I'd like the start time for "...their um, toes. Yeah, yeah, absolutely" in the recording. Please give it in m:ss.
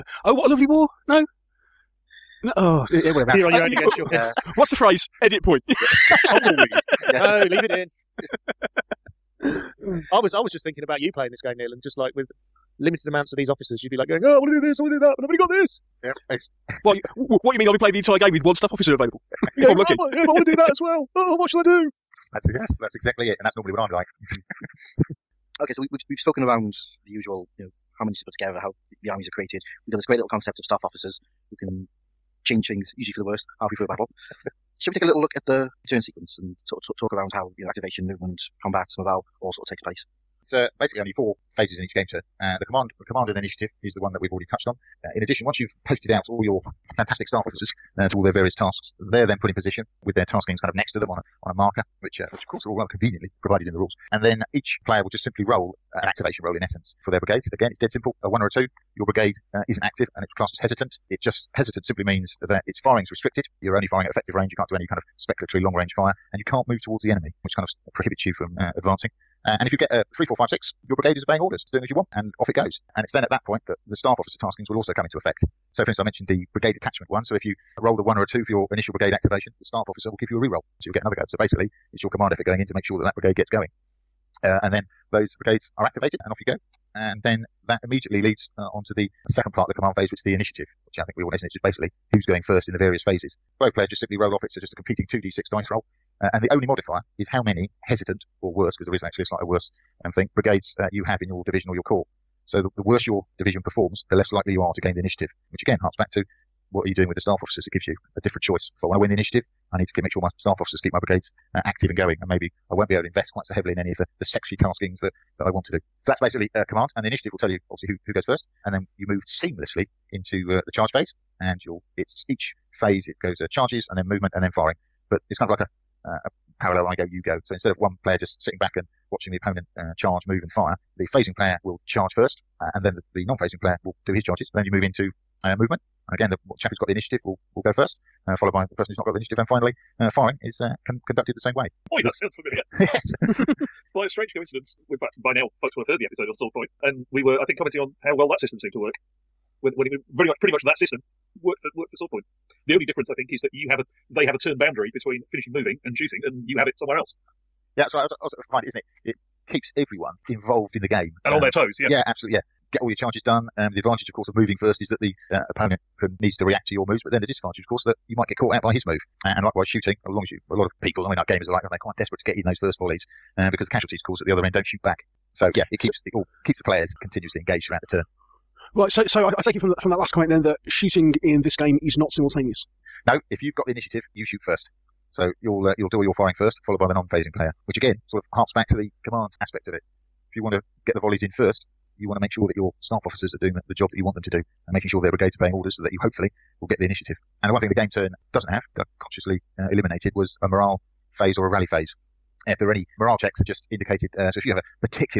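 2:41.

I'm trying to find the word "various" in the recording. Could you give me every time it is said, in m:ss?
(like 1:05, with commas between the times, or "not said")
0:48, 1:32.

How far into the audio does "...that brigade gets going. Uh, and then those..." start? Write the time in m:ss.
1:23.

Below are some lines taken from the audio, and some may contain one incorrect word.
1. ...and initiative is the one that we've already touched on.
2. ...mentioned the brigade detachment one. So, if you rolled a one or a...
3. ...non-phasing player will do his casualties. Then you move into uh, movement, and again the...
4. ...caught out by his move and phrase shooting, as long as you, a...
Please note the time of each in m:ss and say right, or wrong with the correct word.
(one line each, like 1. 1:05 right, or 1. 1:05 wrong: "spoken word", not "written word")
1. 0:43 right
2. 1:16 right
3. 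2:13 wrong: "charges", not "casualties"
4. 2:48 wrong: "likewise", not "phrase".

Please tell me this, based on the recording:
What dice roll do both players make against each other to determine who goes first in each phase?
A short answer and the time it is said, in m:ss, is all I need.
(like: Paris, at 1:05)
2d6, at 1:35.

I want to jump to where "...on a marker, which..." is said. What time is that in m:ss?
0:51.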